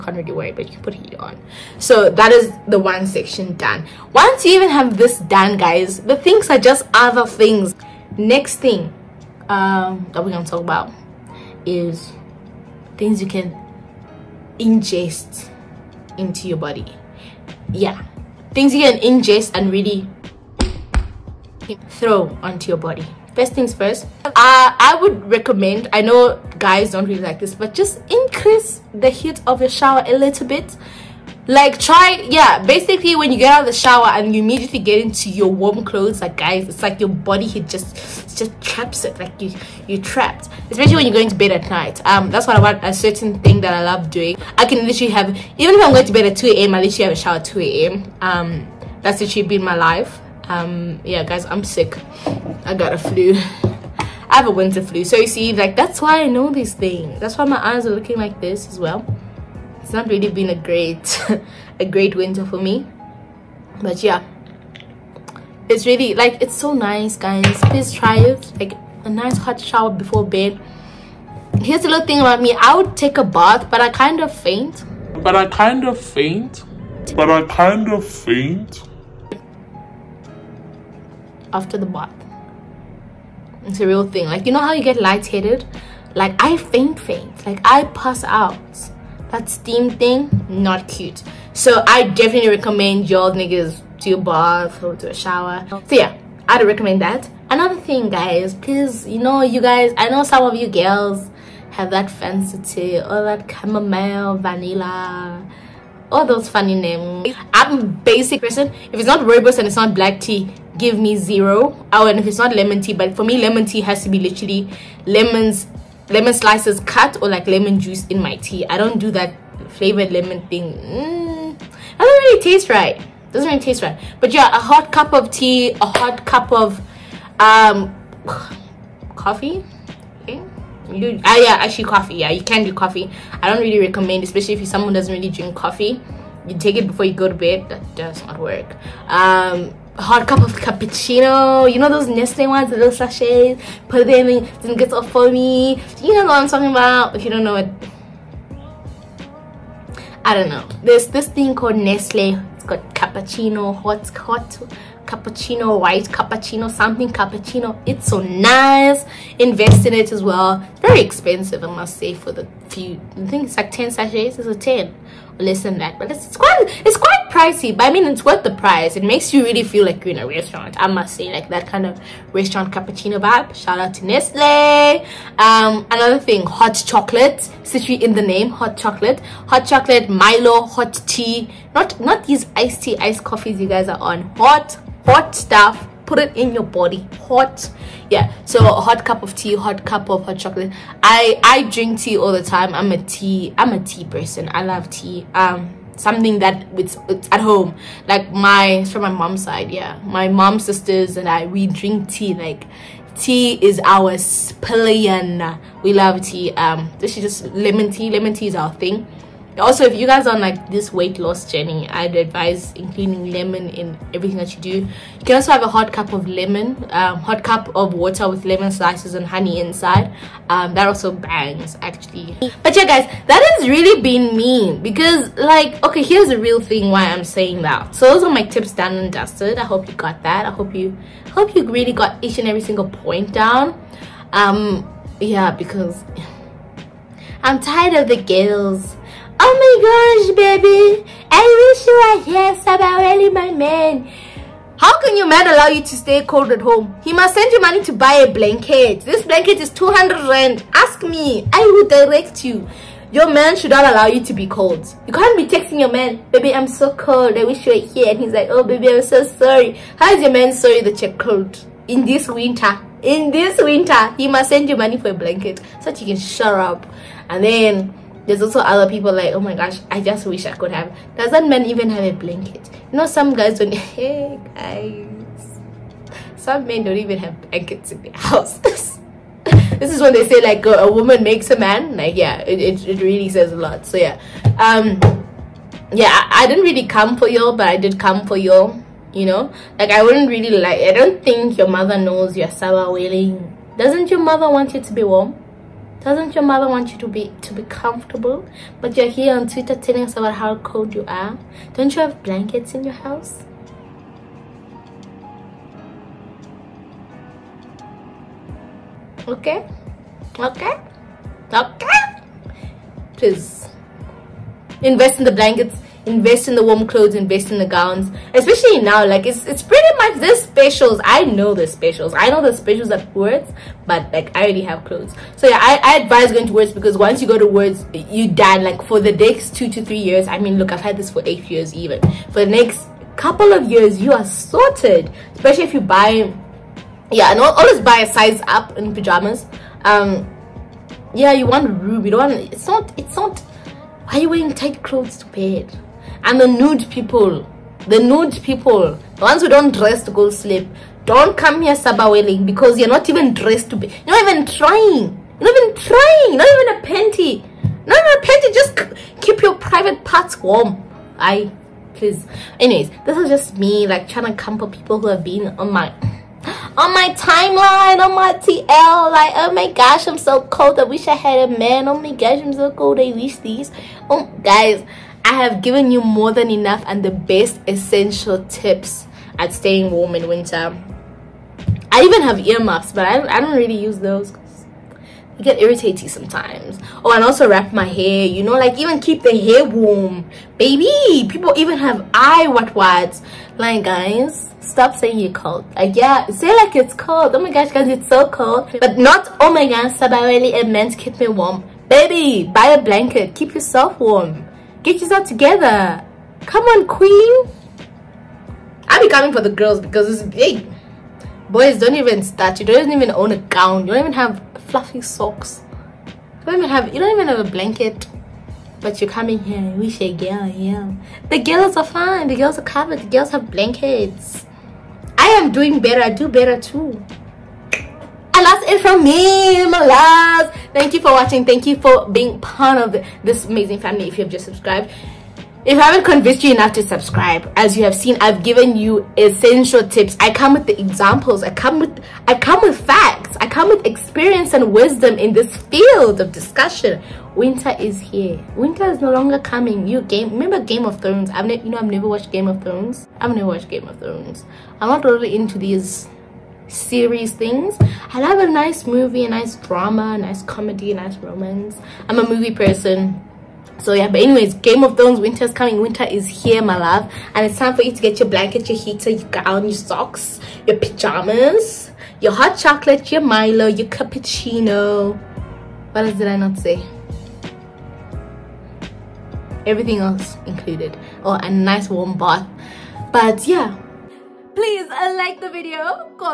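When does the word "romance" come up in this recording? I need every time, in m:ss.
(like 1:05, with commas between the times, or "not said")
7:41.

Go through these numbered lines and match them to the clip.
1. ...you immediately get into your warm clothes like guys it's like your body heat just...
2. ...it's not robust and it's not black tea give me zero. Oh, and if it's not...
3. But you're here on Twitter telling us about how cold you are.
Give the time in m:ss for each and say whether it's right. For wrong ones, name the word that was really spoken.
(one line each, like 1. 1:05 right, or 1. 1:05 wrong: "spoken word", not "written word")
1. 0:34 right
2. 1:48 right
3. 4:58 right.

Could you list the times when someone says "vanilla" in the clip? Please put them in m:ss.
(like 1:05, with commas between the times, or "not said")
1:44.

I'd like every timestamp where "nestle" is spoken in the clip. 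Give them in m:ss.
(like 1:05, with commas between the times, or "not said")
2:22, 2:31, 2:54.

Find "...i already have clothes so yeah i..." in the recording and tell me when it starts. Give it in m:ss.
5:24.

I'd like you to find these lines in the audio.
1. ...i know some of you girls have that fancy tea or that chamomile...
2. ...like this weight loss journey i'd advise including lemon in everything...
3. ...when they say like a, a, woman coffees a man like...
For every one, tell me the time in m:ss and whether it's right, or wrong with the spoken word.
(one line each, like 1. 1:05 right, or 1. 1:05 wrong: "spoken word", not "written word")
1. 1:39 right
2. 3:30 right
3. 4:40 wrong: "makes", not "coffees".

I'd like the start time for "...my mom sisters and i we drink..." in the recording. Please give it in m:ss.
3:20.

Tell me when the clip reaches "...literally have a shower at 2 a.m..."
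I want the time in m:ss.
0:46.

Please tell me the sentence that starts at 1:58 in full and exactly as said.
I don't do that flavored lemon thing.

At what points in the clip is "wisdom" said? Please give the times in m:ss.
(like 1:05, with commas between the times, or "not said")
7:24.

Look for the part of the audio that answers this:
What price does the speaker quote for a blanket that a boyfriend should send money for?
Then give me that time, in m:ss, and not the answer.
4:09.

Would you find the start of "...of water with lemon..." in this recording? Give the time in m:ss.
3:37.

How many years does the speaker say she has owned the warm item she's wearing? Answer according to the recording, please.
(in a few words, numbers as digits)
8.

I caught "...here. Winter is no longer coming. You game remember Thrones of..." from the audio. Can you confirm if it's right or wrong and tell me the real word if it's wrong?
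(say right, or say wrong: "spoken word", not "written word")
wrong: "Game", not "Thrones".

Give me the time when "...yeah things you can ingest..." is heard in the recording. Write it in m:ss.
0:17.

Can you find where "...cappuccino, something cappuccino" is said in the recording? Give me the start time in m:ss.
2:36.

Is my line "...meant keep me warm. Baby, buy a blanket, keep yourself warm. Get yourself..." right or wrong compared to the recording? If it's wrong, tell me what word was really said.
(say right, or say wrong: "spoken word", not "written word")
right.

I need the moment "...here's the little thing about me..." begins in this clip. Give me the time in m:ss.
1:11.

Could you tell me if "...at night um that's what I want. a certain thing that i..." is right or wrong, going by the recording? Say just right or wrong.
right.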